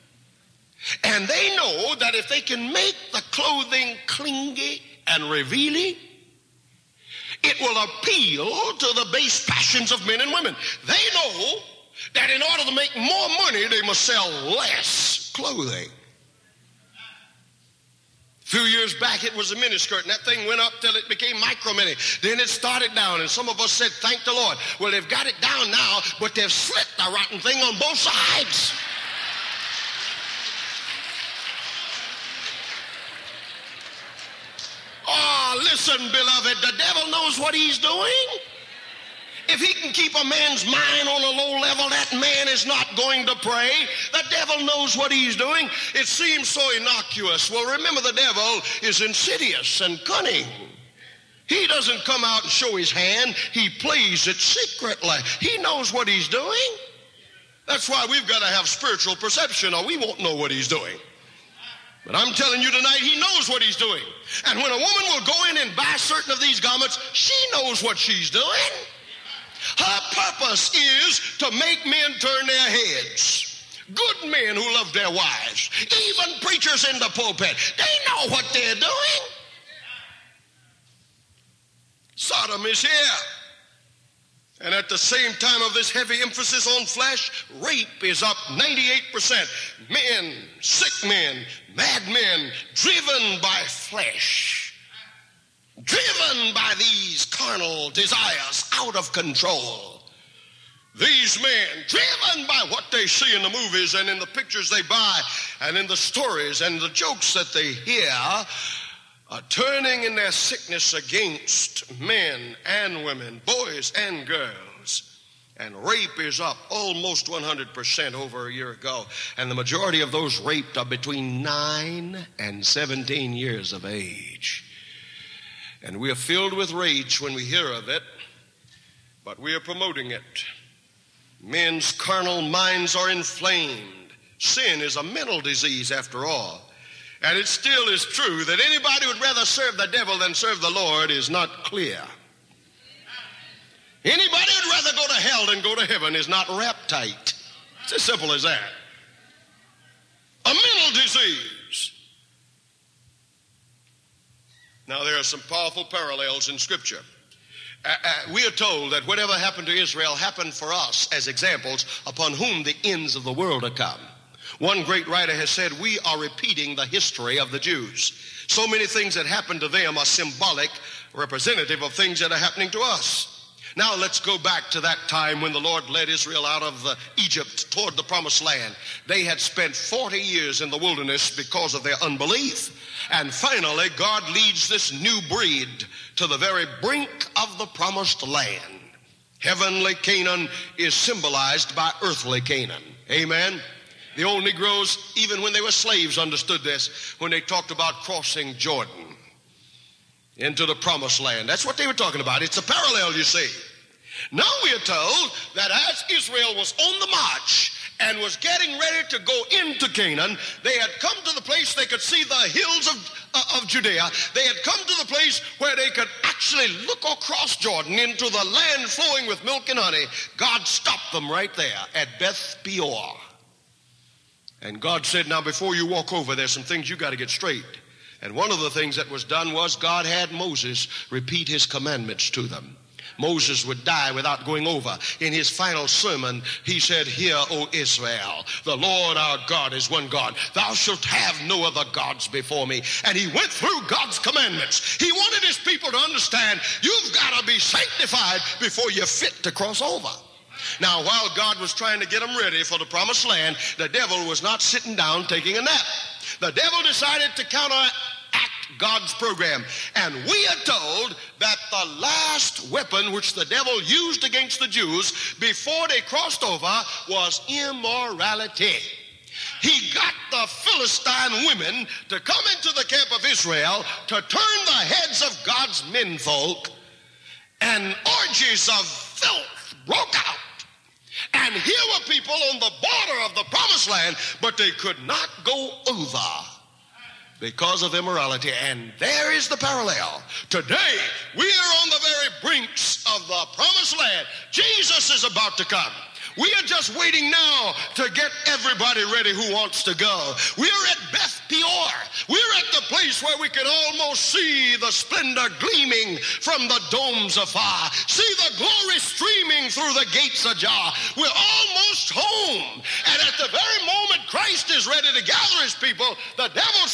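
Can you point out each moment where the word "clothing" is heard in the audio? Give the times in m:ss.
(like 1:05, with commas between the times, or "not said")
0:03, 0:15.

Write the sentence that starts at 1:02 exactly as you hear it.
But I'm telling you tonight, he knows what he's doing.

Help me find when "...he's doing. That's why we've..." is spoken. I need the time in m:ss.
0:56.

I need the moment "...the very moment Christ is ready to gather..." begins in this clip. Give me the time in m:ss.
5:13.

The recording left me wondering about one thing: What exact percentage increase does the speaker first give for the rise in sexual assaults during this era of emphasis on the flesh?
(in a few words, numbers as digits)
98%.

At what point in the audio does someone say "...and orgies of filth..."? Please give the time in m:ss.
4:37.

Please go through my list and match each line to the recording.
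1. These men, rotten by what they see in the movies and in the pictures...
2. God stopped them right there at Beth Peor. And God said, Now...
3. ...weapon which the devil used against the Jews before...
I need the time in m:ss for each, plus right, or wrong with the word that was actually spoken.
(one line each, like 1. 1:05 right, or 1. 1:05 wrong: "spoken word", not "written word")
1. 1:40 wrong: "driven", not "rotten"
2. 3:40 right
3. 4:22 right.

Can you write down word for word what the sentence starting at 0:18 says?
A few years back, it was a miniskirt, and that thing went up till it became micro mini.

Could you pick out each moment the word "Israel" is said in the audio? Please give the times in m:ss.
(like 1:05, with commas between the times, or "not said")
2:39, 2:56, 3:26, 3:57, 4:33.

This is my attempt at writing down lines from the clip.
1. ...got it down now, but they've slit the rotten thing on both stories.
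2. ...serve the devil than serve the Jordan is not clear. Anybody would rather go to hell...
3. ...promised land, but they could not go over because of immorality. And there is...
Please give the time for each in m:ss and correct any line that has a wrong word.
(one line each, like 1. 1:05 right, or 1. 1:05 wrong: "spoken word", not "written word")
1. 0:25 wrong: "sides", not "stories"
2. 2:19 wrong: "Lord", not "Jordan"
3. 4:43 right.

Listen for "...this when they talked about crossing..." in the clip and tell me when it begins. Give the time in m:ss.
3:16.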